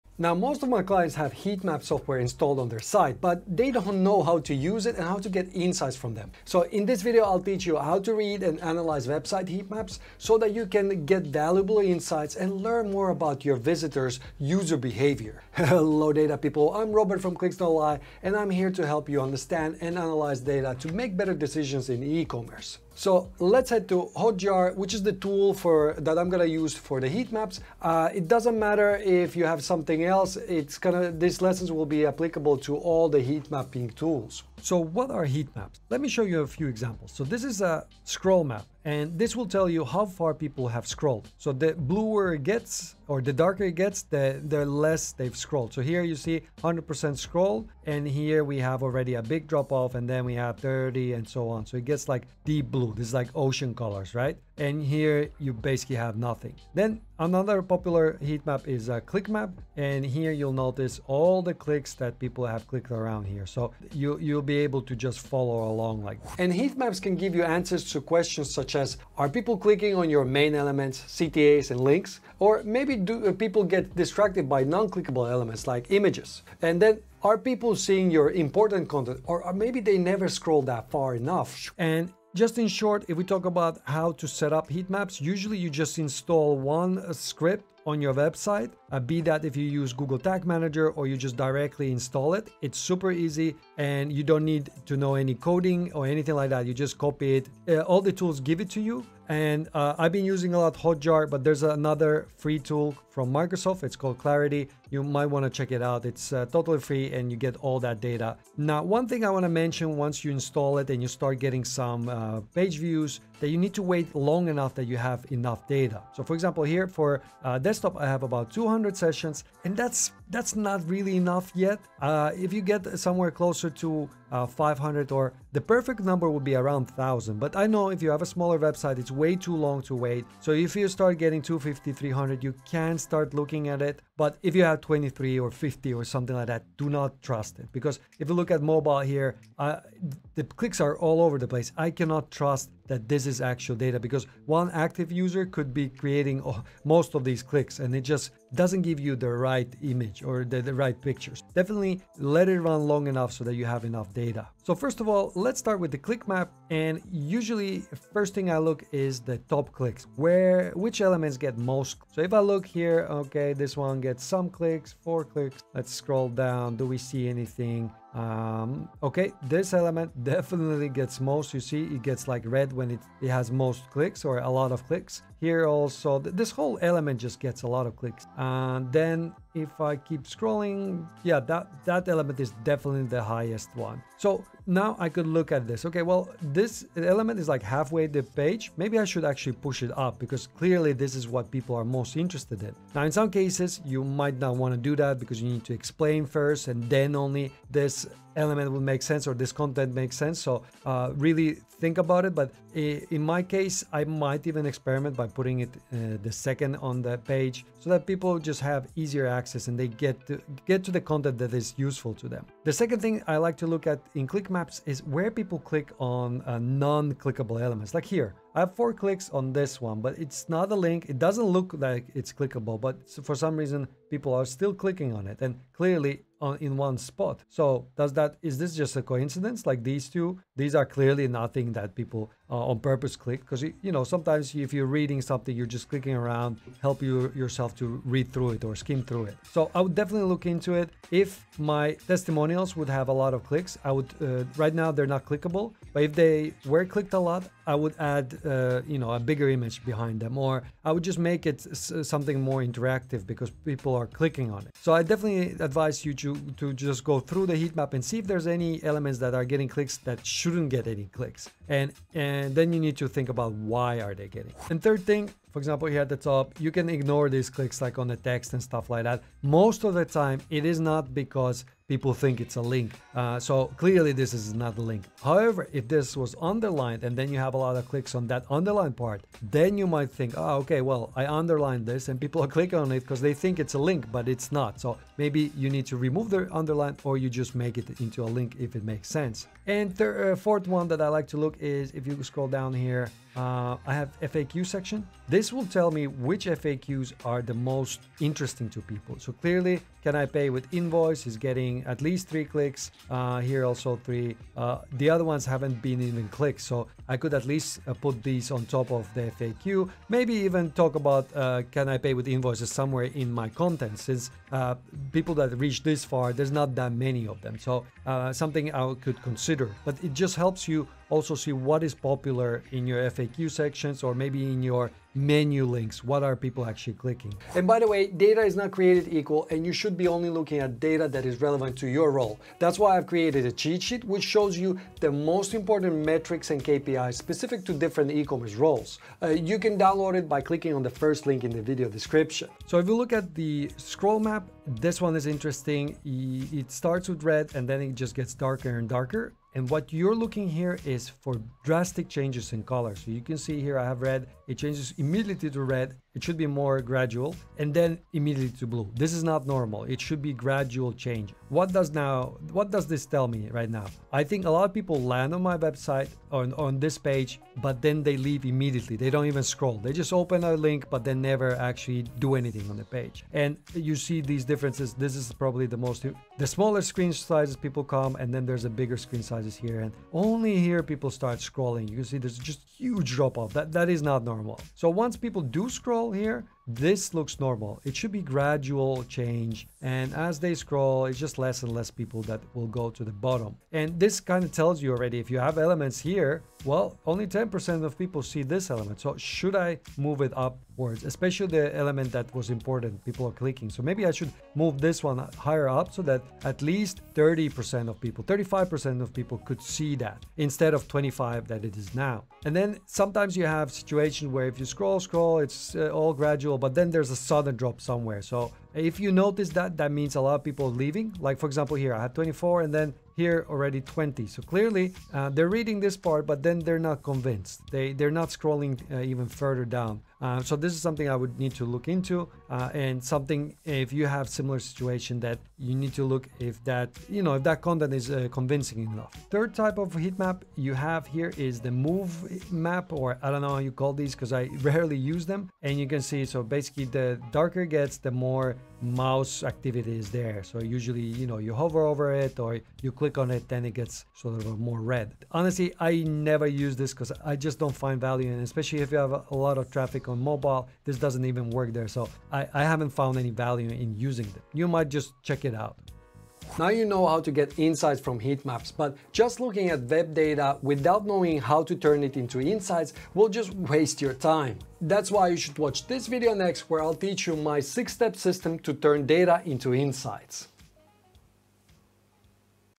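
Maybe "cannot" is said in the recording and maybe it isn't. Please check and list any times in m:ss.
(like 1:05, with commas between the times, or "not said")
2:21.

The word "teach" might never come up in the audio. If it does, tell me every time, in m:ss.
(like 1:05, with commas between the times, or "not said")
0:07, 7:56.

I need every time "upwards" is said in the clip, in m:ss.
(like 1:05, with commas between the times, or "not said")
6:40.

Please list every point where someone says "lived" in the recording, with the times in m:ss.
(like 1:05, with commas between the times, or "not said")
not said.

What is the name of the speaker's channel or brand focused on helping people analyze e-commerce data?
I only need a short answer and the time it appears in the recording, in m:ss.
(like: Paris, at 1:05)
Clicks Don't Lie, at 0:17.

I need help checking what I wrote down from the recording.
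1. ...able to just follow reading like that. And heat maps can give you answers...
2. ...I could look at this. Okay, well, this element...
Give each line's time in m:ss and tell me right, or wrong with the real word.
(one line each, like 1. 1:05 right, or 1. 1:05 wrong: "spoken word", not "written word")
1. 1:04 wrong: "along", not "reading"
2. 3:04 right.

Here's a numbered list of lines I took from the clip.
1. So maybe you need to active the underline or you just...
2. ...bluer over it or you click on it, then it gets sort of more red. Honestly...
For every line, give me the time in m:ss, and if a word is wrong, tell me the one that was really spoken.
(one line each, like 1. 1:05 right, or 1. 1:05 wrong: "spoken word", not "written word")
1. 4:44 wrong: "remove", not "active"
2. 7:31 wrong: "hover", not "bluer".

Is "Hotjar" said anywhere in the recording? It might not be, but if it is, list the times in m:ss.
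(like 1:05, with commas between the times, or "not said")
0:24, 1:40.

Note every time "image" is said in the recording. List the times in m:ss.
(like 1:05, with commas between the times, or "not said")
1:15, 2:29, 4:09.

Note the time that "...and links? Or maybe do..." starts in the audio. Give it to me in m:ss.
1:11.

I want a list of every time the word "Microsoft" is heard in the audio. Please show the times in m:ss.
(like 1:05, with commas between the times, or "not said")
1:43.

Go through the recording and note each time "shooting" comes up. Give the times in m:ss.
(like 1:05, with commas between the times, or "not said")
not said.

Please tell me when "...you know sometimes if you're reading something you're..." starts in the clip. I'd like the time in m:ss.
3:53.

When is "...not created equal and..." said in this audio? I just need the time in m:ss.
5:28.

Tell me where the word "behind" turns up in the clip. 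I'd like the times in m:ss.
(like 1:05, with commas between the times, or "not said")
4:09.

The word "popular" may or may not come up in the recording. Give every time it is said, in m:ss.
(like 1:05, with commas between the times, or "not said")
0:57, 5:21.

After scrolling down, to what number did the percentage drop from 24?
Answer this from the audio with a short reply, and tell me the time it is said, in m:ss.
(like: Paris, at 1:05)
20, at 7:03.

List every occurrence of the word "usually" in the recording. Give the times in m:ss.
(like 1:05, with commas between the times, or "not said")
1:25, 2:37, 7:30.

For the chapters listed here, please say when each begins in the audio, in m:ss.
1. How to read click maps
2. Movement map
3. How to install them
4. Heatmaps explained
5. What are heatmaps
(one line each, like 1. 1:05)
1. 2:34
2. 7:19
3. 1:21
4. 5:27
5. 0:34.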